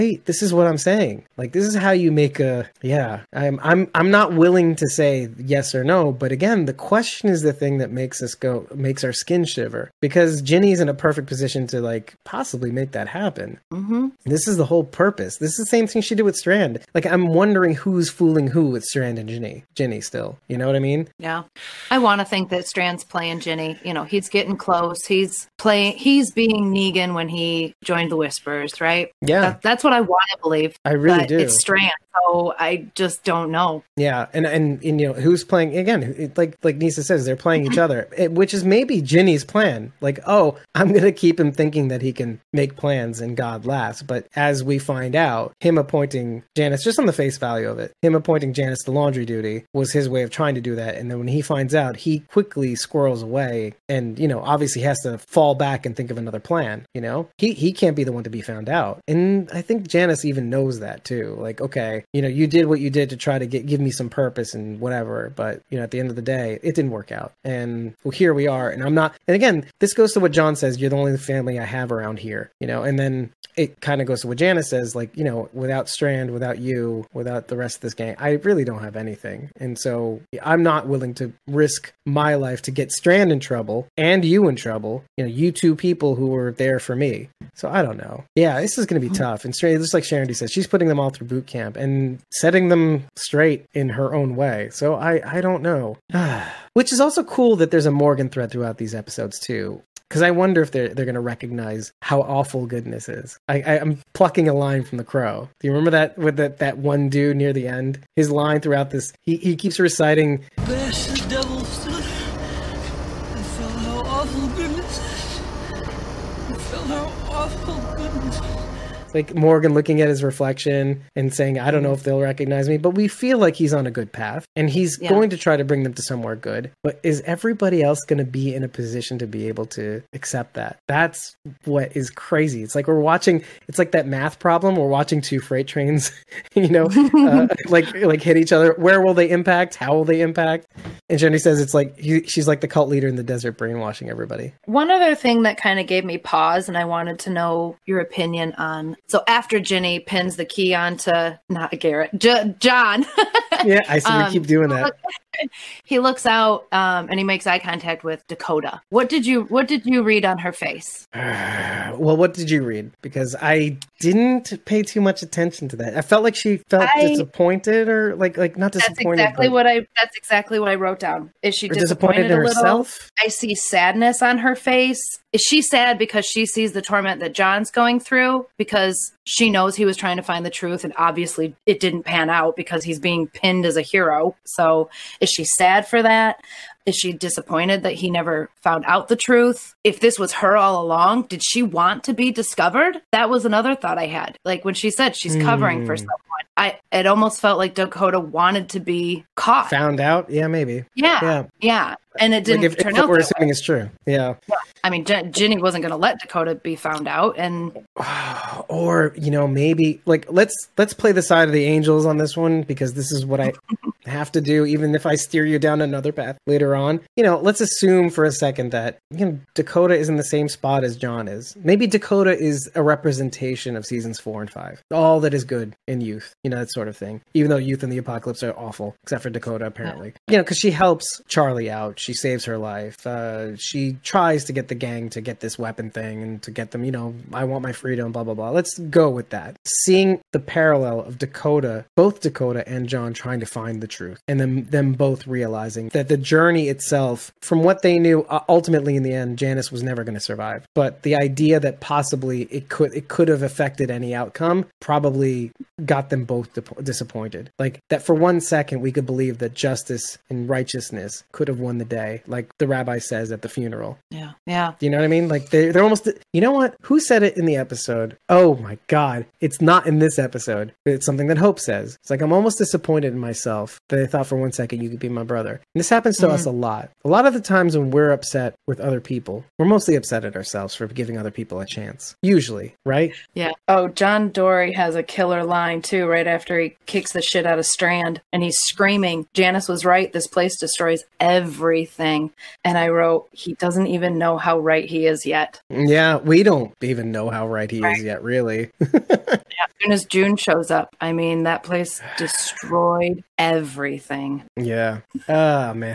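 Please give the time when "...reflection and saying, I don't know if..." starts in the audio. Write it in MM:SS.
02:00.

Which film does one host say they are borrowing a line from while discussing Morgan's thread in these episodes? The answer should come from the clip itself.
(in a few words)
The Crow.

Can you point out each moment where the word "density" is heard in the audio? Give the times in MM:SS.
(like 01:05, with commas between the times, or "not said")
not said.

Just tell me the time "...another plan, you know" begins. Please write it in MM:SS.
00:56.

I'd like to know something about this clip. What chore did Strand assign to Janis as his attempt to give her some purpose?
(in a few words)
Laundry duty.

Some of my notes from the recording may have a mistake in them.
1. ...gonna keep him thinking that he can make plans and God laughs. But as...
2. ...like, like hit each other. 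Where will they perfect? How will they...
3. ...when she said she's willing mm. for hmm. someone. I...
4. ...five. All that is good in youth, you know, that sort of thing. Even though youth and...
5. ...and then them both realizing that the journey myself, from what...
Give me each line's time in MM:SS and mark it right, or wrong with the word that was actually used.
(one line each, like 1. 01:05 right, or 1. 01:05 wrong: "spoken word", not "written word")
1. 00:40 right
2. 02:17 wrong: "impact", not "perfect"
3. 03:14 wrong: "covering", not "willing"
4. 03:44 right
5. 04:04 wrong: "itself", not "myself".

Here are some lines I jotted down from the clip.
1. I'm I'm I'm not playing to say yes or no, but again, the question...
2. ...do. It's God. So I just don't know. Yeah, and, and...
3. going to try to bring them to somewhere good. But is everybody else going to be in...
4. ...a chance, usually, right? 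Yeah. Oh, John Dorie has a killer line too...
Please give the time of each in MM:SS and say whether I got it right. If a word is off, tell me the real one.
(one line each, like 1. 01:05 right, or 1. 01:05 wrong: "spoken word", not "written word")
1. 00:03 wrong: "willing", not "playing"
2. 00:31 wrong: "Strand", not "God"
3. 02:05 right
4. 04:41 right.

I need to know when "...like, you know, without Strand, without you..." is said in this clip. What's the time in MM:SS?
01:14.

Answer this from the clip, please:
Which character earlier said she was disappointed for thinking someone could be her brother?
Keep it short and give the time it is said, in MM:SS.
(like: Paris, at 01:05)
Hope, at 04:31.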